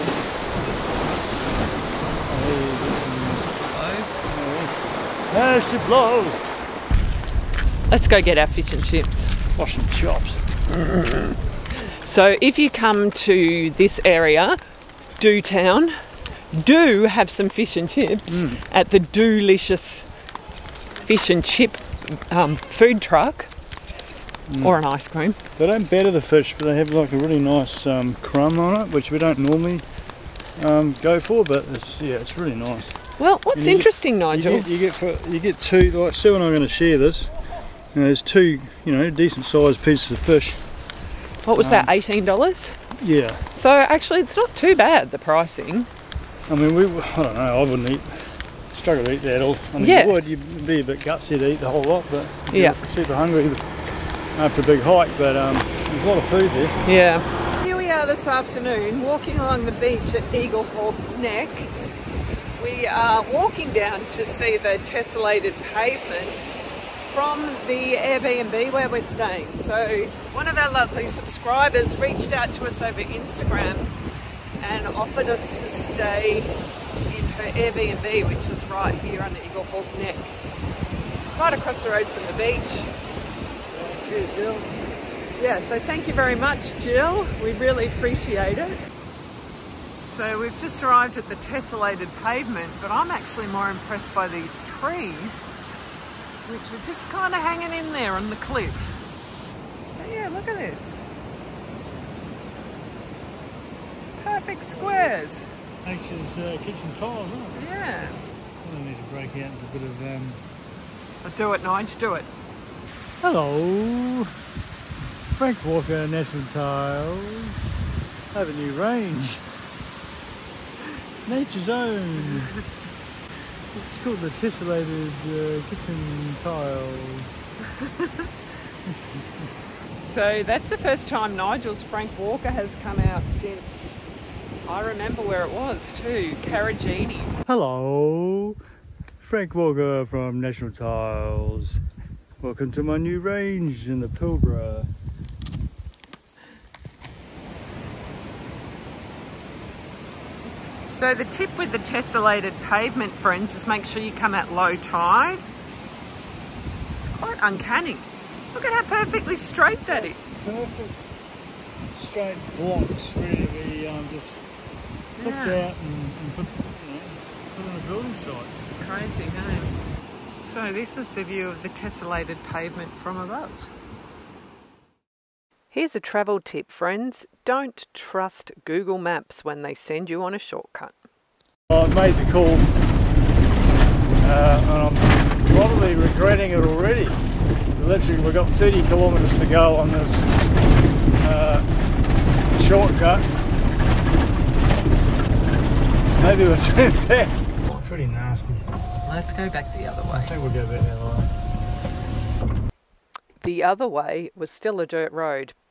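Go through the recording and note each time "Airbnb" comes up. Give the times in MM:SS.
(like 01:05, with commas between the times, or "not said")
01:07, 01:17.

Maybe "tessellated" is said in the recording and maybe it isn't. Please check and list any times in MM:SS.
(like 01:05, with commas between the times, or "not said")
01:04, 01:31, 02:04, 02:31, 02:51.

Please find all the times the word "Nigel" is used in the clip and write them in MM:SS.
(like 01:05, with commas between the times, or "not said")
00:34, 02:11.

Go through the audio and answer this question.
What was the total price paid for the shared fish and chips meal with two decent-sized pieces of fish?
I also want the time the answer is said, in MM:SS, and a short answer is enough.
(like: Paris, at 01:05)
$18, at 00:41.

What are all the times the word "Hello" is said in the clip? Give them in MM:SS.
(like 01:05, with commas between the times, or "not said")
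01:53, 02:17.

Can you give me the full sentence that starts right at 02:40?
Perfect straight blocks, really, um, just yeah.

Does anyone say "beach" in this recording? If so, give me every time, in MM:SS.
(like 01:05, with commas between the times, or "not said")
00:59, 01:22.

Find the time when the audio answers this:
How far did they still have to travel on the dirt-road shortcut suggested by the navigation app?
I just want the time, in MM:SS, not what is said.
03:08.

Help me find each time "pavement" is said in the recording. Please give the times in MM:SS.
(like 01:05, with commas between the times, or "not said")
01:05, 01:32, 02:32, 02:52.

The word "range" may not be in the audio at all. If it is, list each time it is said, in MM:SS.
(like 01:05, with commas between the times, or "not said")
01:58, 02:23.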